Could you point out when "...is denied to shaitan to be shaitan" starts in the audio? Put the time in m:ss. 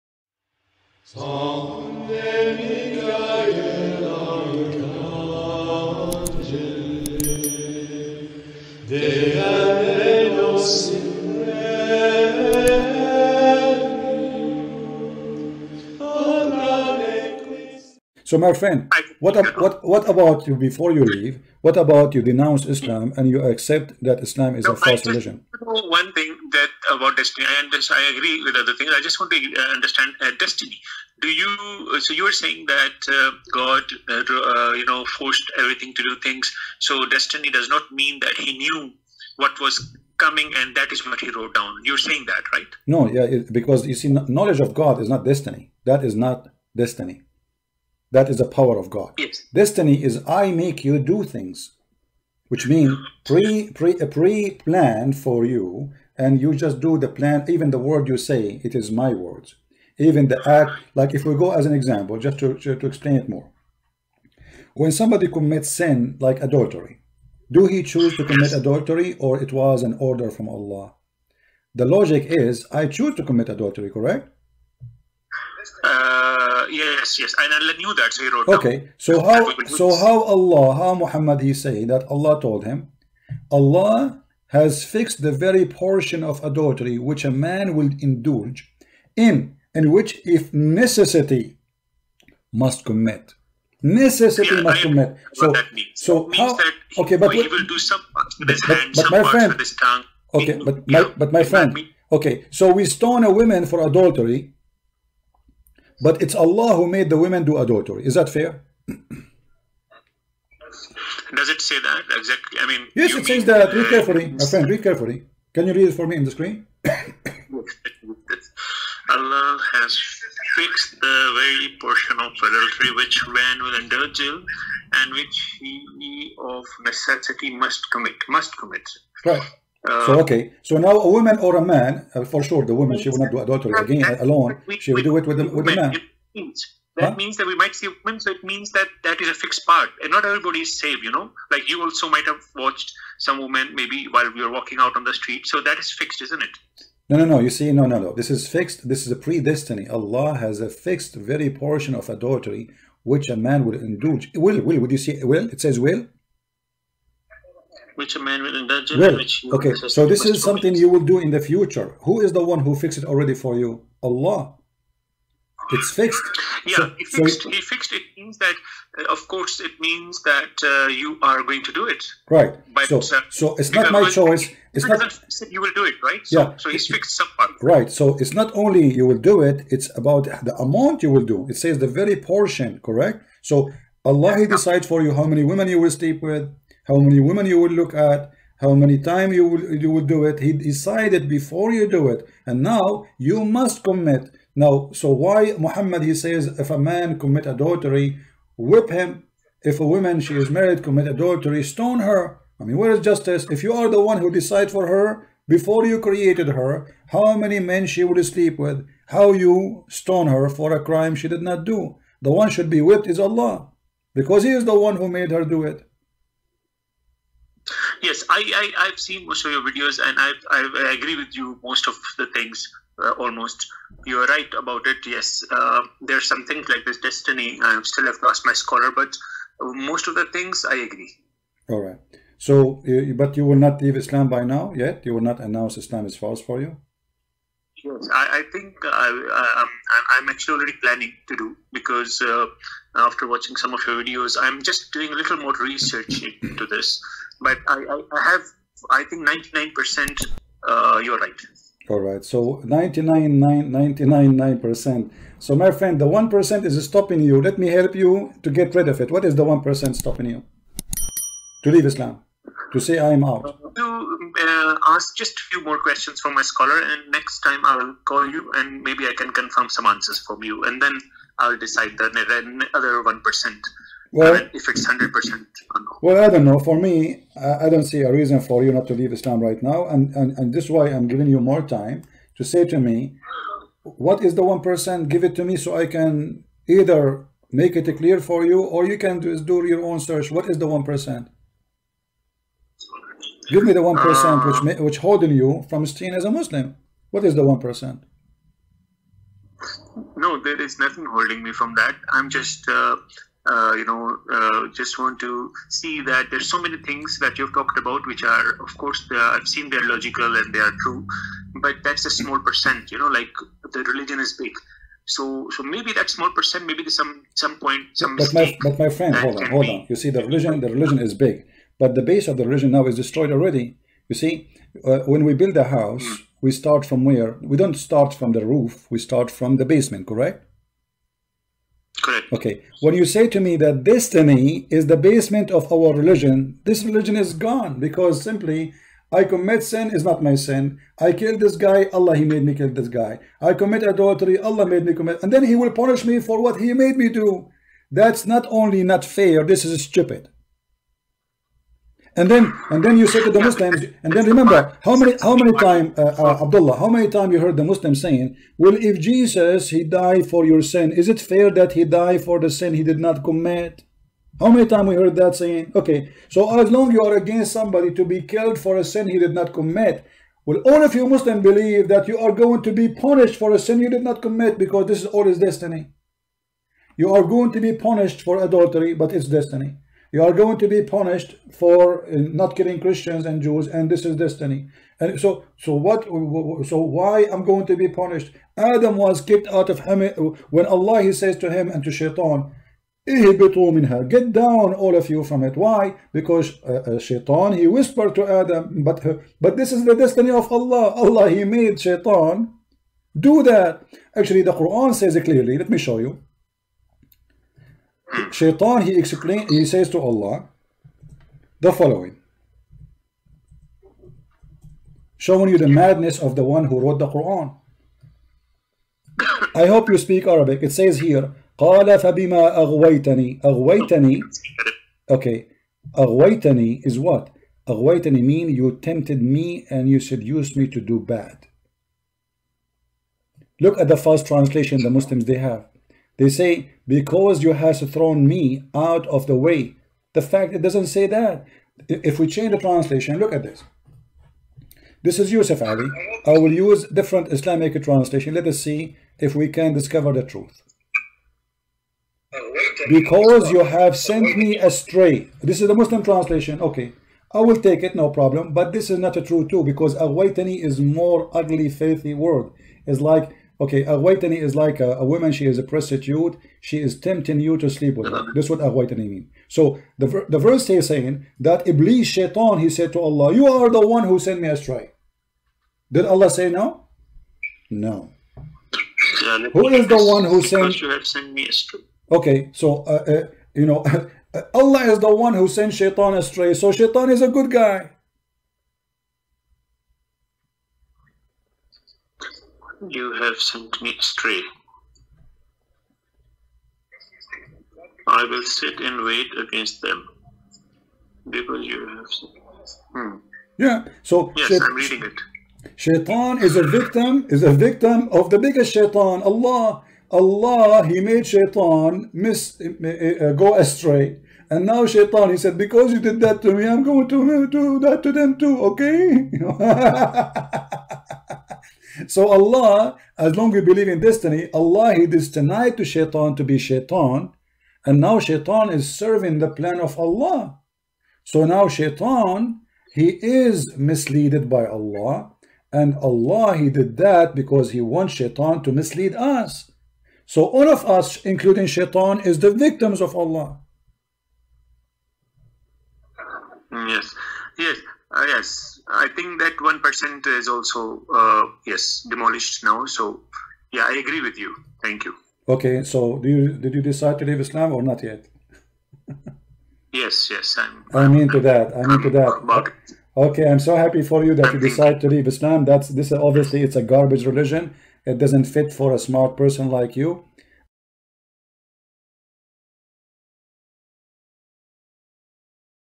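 8:45.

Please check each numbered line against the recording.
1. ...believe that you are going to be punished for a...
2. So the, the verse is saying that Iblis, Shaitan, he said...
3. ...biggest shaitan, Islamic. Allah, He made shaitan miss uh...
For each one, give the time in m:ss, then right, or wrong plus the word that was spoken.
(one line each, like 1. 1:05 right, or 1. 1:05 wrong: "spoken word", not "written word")
1. 6:11 right
2. 7:49 right
3. 8:28 wrong: "Allah", not "Islamic".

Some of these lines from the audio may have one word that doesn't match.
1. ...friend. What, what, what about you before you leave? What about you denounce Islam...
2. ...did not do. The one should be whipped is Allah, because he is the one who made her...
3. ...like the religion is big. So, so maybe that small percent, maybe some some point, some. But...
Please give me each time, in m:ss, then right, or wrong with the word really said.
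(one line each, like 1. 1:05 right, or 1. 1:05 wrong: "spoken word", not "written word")
1. 0:18 right
2. 3:31 right
3. 5:13 right.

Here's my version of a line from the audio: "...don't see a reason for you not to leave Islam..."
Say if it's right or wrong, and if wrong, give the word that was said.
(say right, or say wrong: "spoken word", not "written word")
right.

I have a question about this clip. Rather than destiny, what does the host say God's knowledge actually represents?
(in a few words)
The power of God.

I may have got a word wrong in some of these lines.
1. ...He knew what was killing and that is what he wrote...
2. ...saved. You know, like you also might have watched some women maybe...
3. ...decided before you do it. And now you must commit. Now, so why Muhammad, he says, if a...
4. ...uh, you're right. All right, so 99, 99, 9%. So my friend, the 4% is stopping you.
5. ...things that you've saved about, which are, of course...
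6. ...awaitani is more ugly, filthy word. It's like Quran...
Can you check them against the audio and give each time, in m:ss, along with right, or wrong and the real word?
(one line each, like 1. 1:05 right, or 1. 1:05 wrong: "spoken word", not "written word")
1. 0:38 wrong: "coming", not "killing"
2. 2:20 right
3. 3:10 right
4. 4:10 wrong: "1", not "4"
5. 5:06 wrong: "talked", not "saved"
6. 7:39 wrong: "Okay", not "Quran".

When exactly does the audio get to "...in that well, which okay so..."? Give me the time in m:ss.
2:38.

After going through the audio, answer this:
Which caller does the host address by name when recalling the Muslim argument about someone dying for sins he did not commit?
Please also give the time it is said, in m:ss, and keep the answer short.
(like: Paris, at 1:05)
Abdullah, at 5:56.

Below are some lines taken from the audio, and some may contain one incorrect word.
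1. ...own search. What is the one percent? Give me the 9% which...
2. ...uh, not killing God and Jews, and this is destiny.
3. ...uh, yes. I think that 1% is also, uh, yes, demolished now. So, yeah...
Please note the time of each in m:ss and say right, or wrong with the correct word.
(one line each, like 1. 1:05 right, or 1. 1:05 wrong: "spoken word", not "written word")
1. 4:49 wrong: "1", not "9"
2. 6:22 wrong: "Christians", not "God"
3. 9:08 right.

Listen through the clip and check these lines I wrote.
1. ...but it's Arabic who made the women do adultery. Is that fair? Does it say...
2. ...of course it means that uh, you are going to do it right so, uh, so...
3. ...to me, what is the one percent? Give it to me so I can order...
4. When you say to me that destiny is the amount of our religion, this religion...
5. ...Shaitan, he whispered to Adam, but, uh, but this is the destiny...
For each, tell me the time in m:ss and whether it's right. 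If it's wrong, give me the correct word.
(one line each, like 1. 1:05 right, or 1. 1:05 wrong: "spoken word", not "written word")
1. 1:46 wrong: "Allah", not "Arabic"
2. 2:49 right
3. 4:42 wrong: "either", not "order"
4. 5:32 wrong: "basement", not "amount"
5. 6:36 right.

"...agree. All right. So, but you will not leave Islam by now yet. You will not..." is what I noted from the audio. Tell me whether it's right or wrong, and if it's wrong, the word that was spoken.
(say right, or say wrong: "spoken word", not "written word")
right.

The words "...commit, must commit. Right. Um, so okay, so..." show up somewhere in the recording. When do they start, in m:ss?
2:07.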